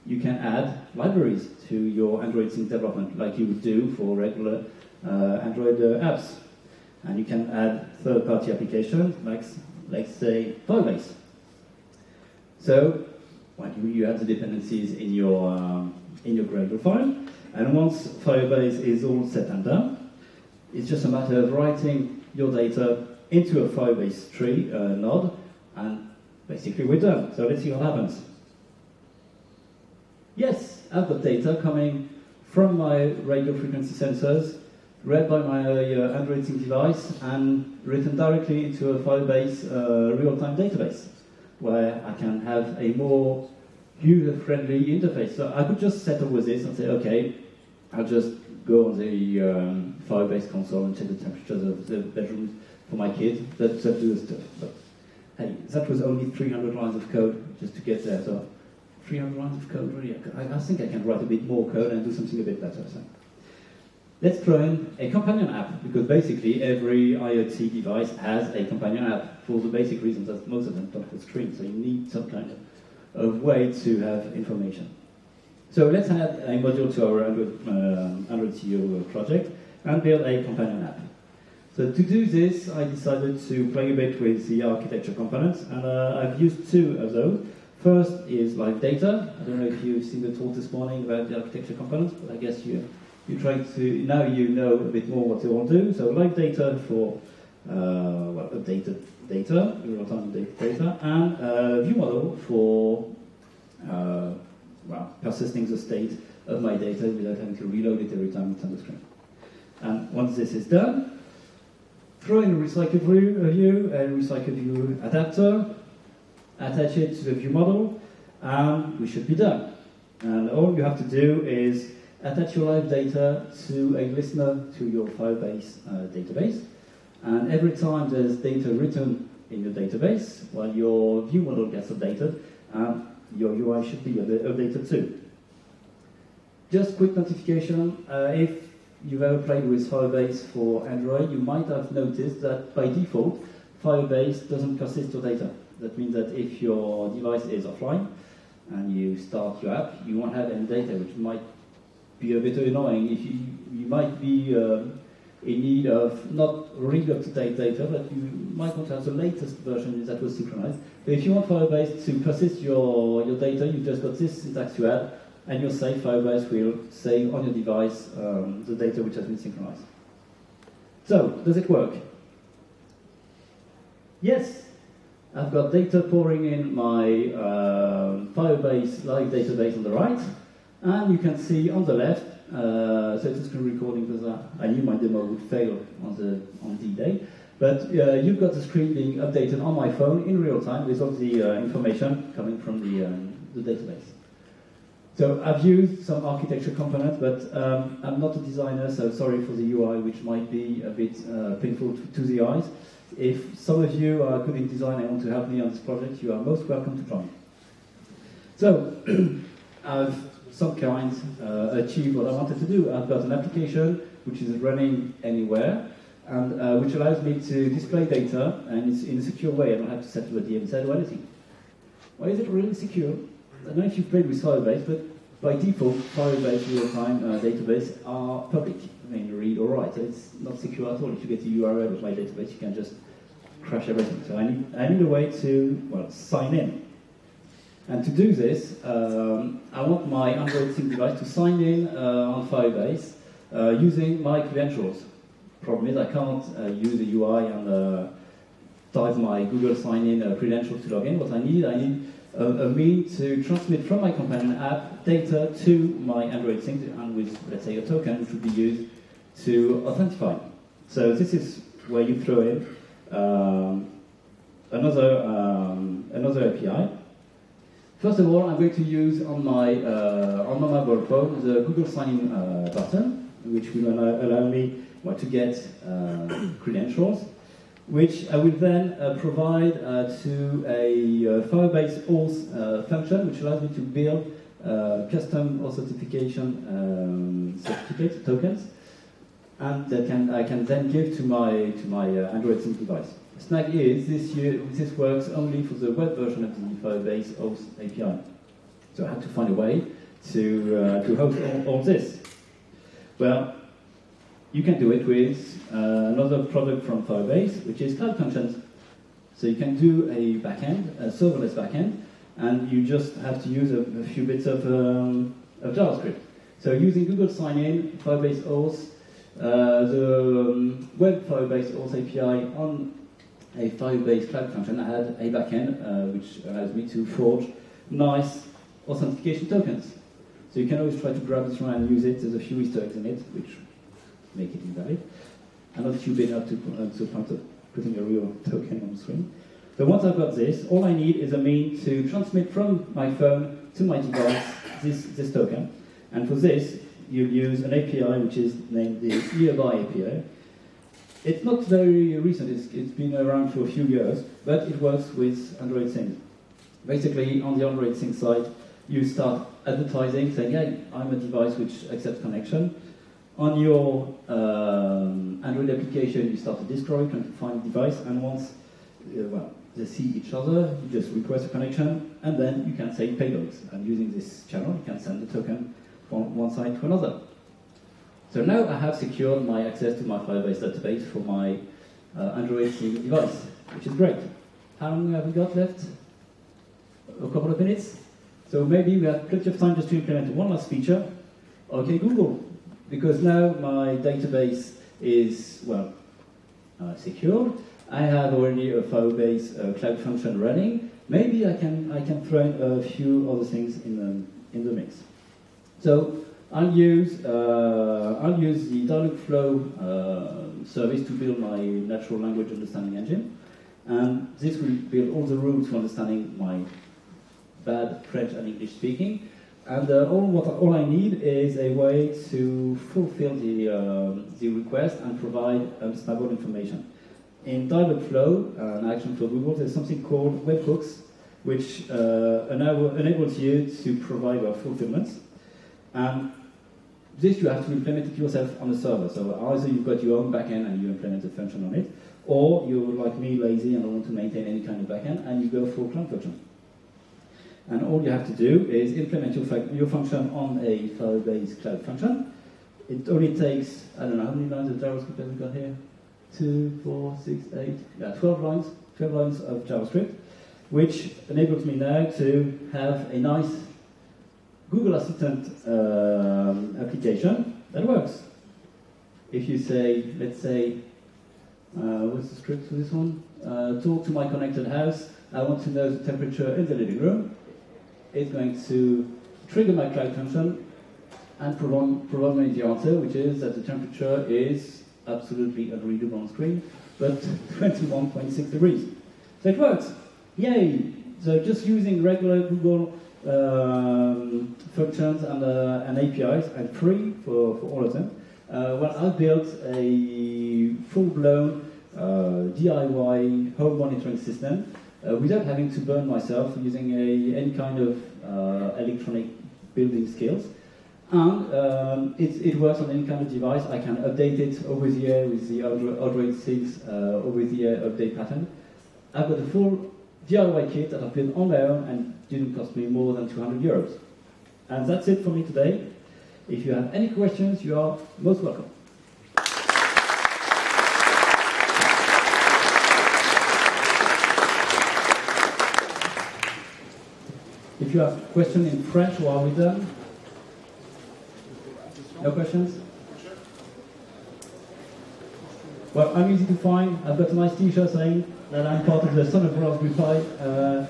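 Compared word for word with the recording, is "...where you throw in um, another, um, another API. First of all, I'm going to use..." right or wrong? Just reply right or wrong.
right.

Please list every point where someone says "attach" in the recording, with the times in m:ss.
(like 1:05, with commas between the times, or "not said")
1:56, 2:02.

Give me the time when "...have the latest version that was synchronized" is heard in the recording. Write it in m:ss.
2:38.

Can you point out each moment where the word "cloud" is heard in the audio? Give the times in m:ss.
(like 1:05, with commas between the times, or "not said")
5:07, 5:24, 6:39, 7:31, 7:59.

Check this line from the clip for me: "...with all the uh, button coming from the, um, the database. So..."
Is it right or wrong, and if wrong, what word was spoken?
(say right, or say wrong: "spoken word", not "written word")
wrong: "information", not "button".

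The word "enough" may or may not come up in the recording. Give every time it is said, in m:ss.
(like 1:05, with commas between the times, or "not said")
5:36.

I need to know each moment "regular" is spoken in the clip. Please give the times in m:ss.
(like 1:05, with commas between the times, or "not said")
0:04, 8:12.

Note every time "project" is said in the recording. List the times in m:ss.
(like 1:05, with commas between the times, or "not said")
1:19, 3:25.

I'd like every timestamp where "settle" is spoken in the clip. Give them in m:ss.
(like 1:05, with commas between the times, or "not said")
0:46, 3:40.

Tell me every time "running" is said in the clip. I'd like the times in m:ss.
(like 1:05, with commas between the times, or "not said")
3:34, 6:40.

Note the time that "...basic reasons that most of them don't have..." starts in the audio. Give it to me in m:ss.
1:09.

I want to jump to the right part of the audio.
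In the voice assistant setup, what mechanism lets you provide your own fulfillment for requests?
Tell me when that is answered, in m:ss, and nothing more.
7:10.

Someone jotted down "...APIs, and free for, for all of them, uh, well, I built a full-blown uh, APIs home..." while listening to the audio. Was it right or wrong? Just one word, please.
wrong.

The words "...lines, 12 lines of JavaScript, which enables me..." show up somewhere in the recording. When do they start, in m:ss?
7:38.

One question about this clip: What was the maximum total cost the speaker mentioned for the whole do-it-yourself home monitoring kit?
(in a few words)
200 euros.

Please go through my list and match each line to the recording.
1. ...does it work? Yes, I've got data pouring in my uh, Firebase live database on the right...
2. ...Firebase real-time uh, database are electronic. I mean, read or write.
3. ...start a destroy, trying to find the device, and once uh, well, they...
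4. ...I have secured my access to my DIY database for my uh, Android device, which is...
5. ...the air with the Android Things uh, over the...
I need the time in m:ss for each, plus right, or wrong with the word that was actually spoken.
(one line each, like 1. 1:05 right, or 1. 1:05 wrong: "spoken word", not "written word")
1. 2:51 right
2. 3:46 wrong: "public", not "electronic"
3. 6:06 right
4. 6:18 wrong: "Firebase", not "DIY"
5. 8:34 right.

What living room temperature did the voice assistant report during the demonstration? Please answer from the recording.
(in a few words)
21.6 degrees.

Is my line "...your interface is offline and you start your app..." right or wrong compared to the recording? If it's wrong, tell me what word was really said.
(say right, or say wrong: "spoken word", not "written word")
wrong: "device", not "interface".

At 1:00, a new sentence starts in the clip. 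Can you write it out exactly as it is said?
I, I think I can write a bit more code and do something a bit better.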